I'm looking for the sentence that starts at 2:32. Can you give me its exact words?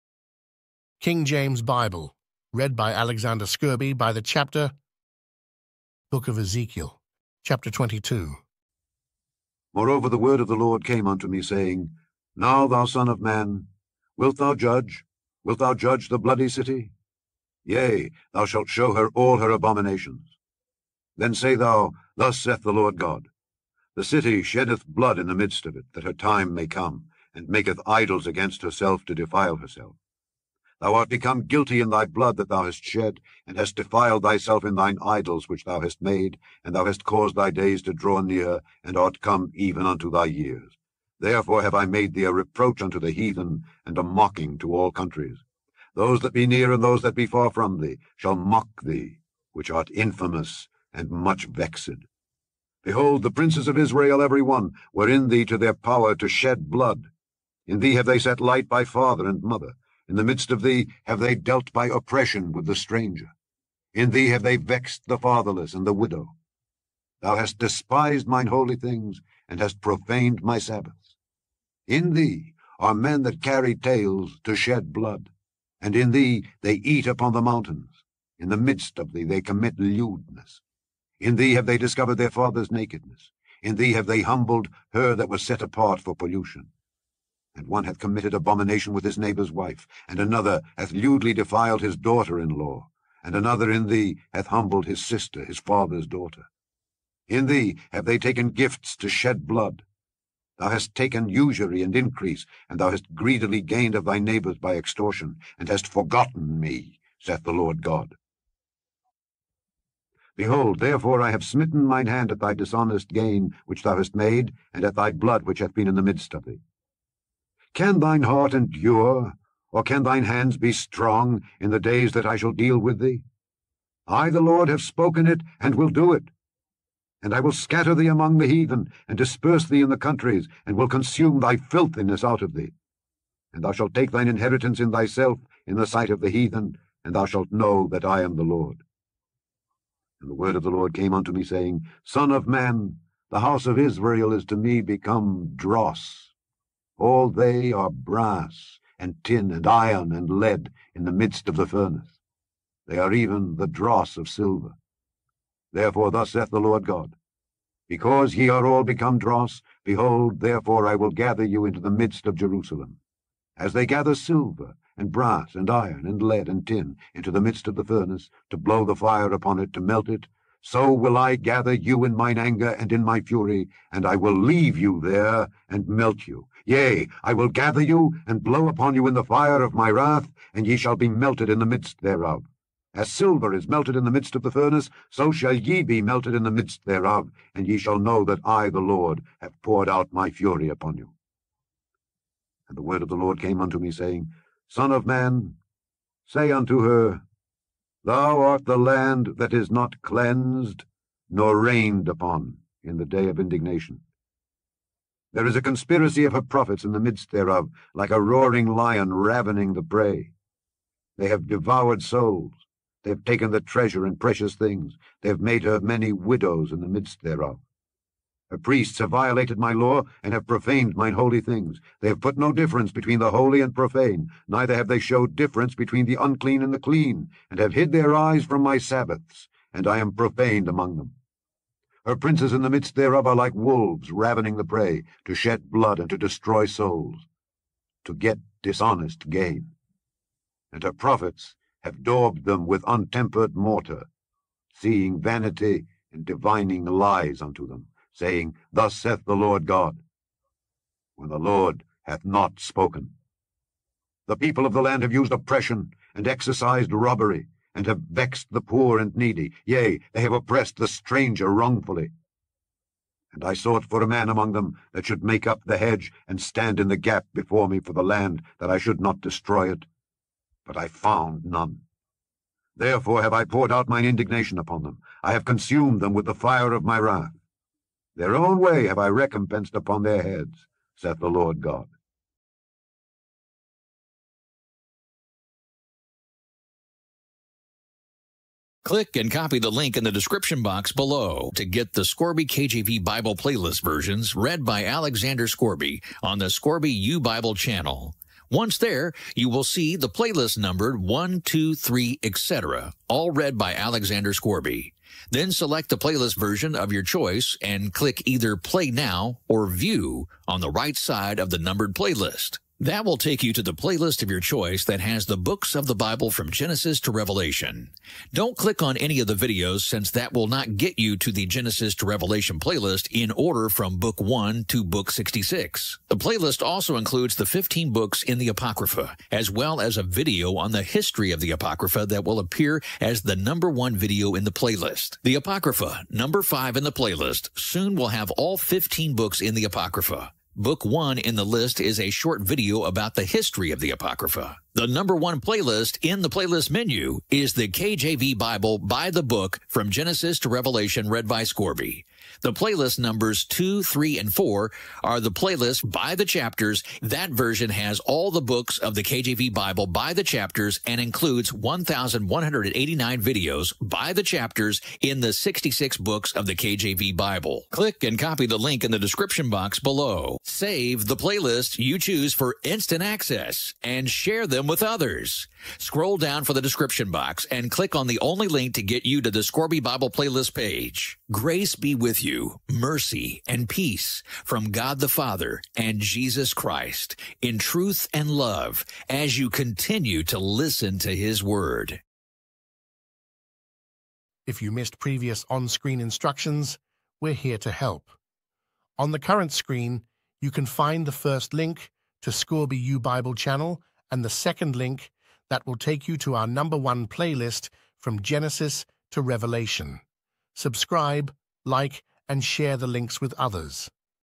They are even the dross of silver.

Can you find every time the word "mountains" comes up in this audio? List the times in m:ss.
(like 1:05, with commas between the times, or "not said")
1:17.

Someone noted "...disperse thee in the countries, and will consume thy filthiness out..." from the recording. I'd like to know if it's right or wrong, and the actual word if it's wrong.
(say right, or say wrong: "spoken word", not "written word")
right.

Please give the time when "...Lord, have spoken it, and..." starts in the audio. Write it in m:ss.
2:04.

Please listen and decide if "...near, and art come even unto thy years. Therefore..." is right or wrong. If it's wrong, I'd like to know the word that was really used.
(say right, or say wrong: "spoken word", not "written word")
right.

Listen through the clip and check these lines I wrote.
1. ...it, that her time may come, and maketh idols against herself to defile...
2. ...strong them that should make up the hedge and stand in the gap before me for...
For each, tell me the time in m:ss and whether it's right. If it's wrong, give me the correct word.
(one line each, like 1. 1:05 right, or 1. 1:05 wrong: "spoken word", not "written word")
1. 0:25 right
2. 4:24 wrong: "among", not "strong".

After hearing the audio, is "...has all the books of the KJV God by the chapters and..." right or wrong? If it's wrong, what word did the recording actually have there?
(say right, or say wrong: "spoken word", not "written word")
wrong: "Bible", not "God".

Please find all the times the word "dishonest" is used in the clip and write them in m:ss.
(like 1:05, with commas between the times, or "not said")
1:52, 3:58.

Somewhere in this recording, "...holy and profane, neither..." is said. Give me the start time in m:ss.
3:43.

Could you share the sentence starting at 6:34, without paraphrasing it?
If you missed previous on-screen instructions, we're here to help.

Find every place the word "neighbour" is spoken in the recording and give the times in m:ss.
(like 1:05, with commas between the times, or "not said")
1:29, 1:44.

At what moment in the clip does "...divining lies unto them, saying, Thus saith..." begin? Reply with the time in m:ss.
4:06.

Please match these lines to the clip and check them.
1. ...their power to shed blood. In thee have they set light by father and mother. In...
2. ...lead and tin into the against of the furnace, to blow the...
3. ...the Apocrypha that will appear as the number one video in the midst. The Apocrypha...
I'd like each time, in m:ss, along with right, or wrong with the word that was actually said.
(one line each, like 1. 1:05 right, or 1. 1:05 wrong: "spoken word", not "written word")
1. 0:55 right
2. 2:46 wrong: "midst", not "against"
3. 5:31 wrong: "playlist", not "midst".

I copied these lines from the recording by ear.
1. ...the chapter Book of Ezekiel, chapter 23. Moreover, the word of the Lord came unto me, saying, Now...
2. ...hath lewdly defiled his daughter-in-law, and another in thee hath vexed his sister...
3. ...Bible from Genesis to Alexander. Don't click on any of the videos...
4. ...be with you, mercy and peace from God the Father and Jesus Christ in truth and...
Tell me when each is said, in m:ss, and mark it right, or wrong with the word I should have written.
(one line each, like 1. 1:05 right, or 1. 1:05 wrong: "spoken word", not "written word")
1. 0:04 wrong: "22", not "23"
2. 1:30 wrong: "humbled", not "vexed"
3. 5:15 wrong: "Revelation", not "Alexander"
4. 6:21 right.